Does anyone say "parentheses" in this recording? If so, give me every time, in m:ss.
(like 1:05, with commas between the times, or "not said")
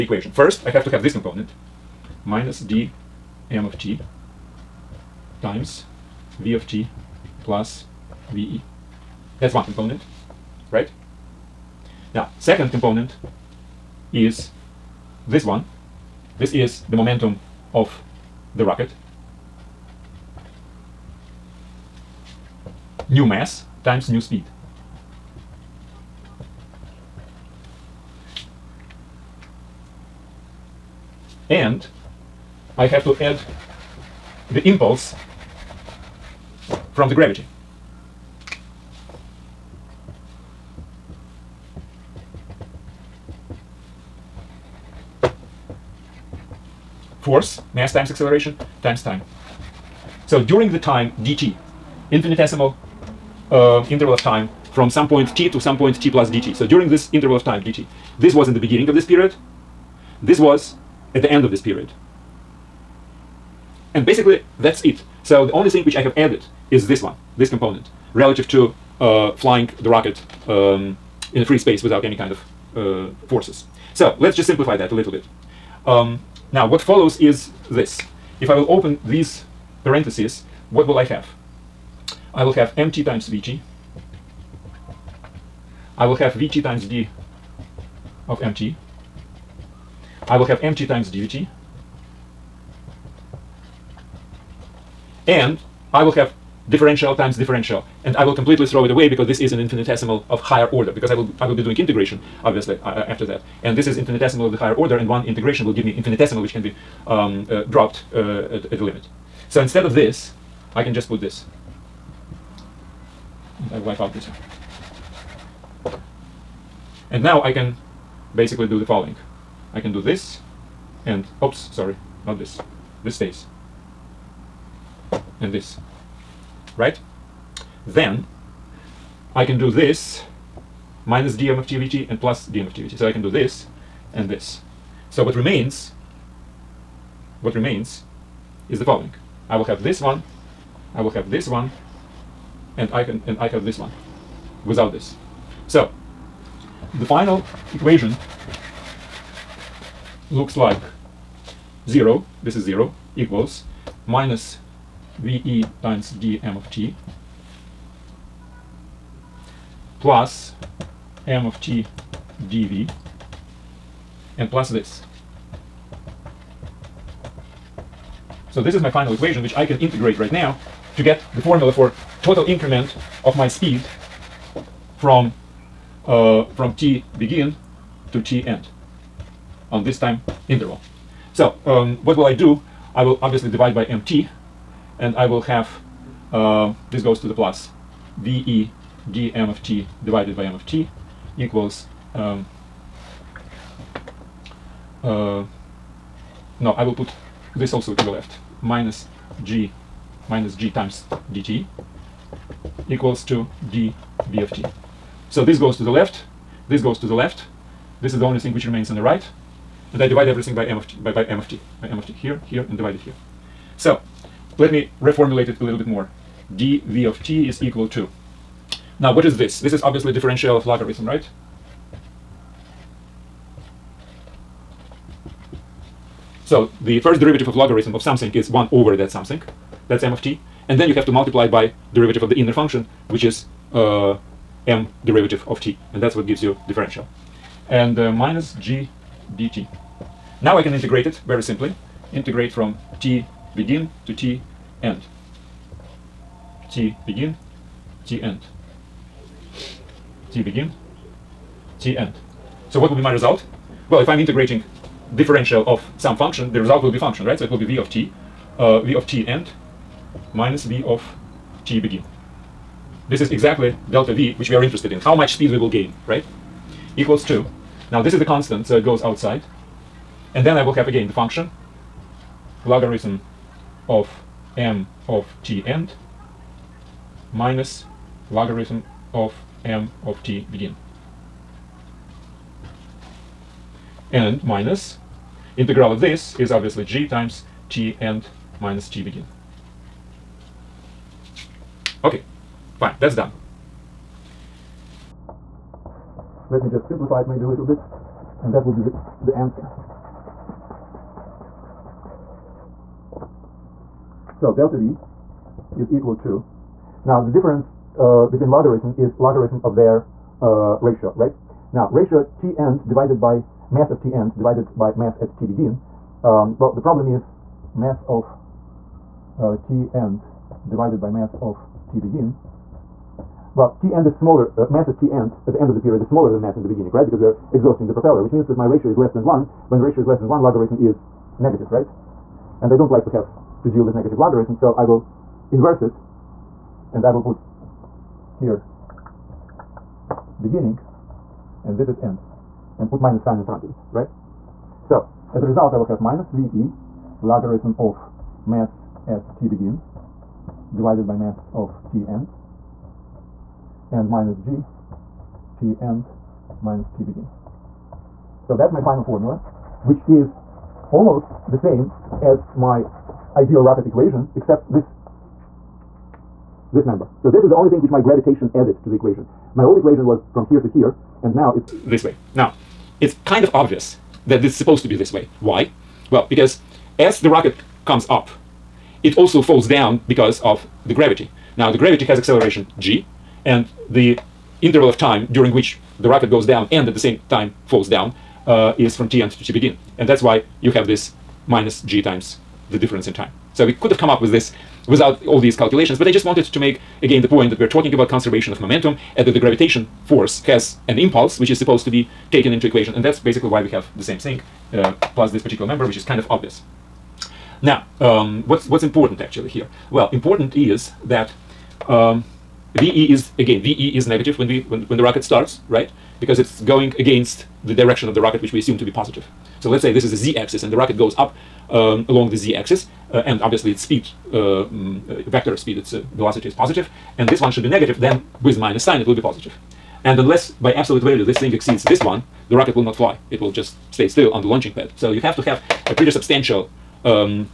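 1:19.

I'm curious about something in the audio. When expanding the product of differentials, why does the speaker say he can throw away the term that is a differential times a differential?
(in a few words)
Infinitesimal of higher order.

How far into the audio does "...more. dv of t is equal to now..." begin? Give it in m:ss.
3:35.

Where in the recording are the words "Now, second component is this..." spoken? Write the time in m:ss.
0:12.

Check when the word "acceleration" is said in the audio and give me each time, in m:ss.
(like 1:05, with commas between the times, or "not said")
0:48, 6:22.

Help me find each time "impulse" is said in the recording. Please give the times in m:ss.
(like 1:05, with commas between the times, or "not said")
0:34, 6:40.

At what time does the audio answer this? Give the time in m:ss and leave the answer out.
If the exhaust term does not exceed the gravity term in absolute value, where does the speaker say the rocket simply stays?
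7:14.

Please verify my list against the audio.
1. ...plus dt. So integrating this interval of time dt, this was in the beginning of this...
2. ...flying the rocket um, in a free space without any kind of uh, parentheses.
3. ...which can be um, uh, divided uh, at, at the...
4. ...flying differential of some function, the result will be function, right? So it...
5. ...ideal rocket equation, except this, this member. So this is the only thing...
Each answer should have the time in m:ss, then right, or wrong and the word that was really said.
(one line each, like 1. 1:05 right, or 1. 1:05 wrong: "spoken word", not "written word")
1. 0:56 wrong: "during", not "integrating"
2. 1:09 wrong: "forces", not "parentheses"
3. 1:46 wrong: "dropped", not "divided"
4. 4:14 wrong: "integrating", not "flying"
5. 6:03 right.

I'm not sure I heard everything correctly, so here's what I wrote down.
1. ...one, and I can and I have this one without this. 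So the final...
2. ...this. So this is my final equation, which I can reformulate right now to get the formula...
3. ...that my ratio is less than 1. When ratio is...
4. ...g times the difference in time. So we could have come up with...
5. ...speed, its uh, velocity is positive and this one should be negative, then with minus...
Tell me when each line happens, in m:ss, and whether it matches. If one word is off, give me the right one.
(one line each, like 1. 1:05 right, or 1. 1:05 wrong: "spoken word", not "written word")
1. 2:21 right
2. 2:44 wrong: "integrate", not "reformulate"
3. 5:28 right
4. 6:31 right
5. 7:05 right.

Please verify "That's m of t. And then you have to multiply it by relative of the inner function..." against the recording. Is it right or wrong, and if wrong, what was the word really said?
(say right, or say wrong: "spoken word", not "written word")
wrong: "derivative", not "relative".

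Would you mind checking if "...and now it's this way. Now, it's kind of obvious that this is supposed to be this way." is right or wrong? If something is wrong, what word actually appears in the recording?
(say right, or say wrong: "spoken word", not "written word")
right.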